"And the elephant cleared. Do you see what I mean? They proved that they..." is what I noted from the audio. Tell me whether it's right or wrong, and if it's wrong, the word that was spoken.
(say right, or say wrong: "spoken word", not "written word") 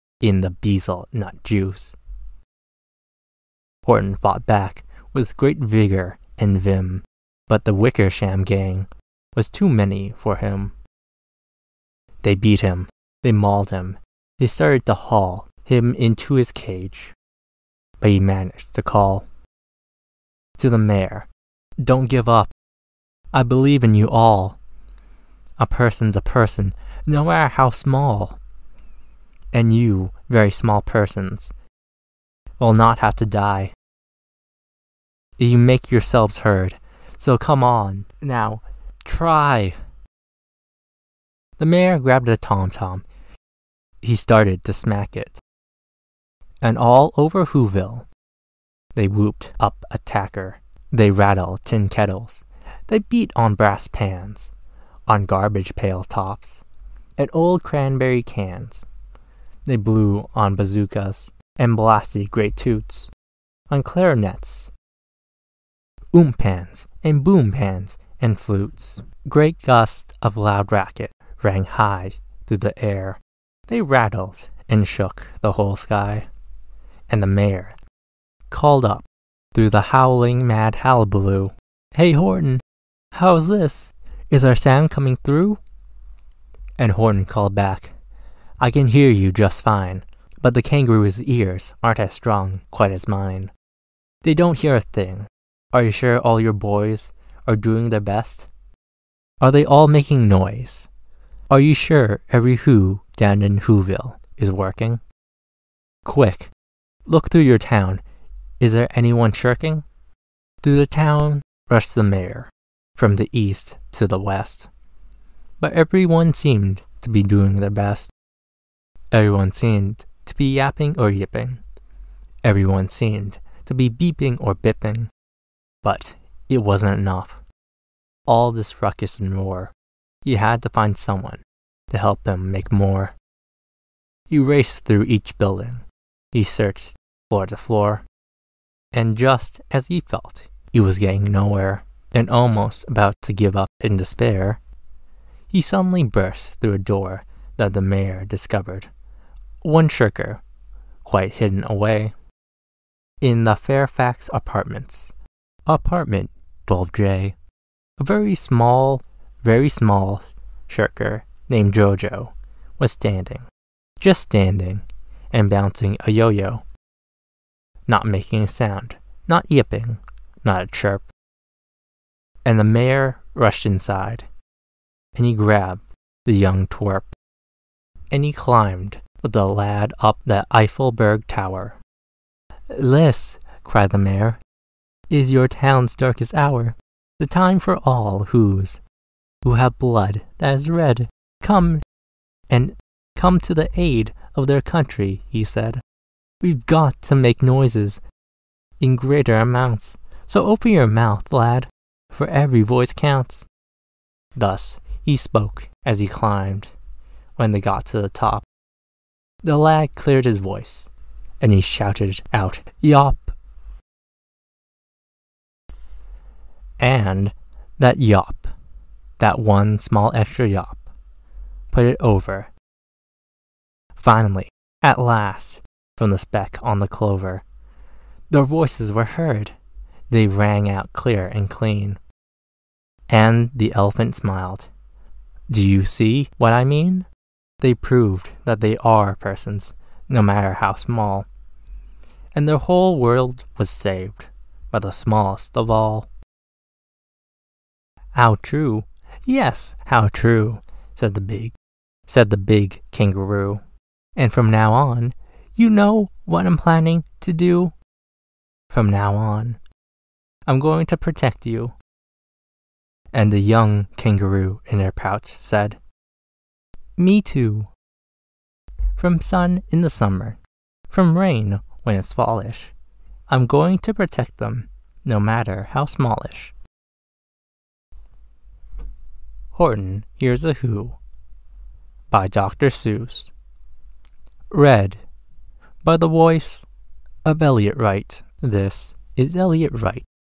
wrong: "smiled", not "cleared".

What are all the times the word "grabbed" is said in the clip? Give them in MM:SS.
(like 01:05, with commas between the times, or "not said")
00:42, 02:55.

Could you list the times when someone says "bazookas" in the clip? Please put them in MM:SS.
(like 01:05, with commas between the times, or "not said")
01:00.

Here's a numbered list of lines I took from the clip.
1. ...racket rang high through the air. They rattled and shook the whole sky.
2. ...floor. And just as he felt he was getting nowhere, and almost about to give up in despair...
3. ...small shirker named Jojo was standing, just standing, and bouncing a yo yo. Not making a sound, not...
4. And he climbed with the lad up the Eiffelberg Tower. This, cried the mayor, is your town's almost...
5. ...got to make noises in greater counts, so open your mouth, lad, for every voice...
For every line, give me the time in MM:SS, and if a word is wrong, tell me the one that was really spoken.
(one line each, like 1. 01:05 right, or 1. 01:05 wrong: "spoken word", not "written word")
1. 01:10 right
2. 02:17 right
3. 02:39 right
4. 02:58 wrong: "darkest", not "almost"
5. 03:16 wrong: "amounts", not "counts".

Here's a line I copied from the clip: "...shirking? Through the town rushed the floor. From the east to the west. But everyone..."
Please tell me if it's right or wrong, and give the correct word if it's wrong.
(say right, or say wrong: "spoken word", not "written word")
wrong: "mayor", not "floor".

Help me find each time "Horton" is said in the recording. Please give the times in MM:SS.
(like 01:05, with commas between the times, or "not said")
00:03, 01:22, 01:26, 04:39.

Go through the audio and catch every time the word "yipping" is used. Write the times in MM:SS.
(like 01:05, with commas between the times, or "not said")
02:01, 02:49.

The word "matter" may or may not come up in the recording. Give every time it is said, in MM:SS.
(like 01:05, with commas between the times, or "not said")
00:27, 04:00, 04:35.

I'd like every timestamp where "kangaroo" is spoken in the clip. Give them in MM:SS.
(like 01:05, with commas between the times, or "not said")
01:30, 04:12, 04:23.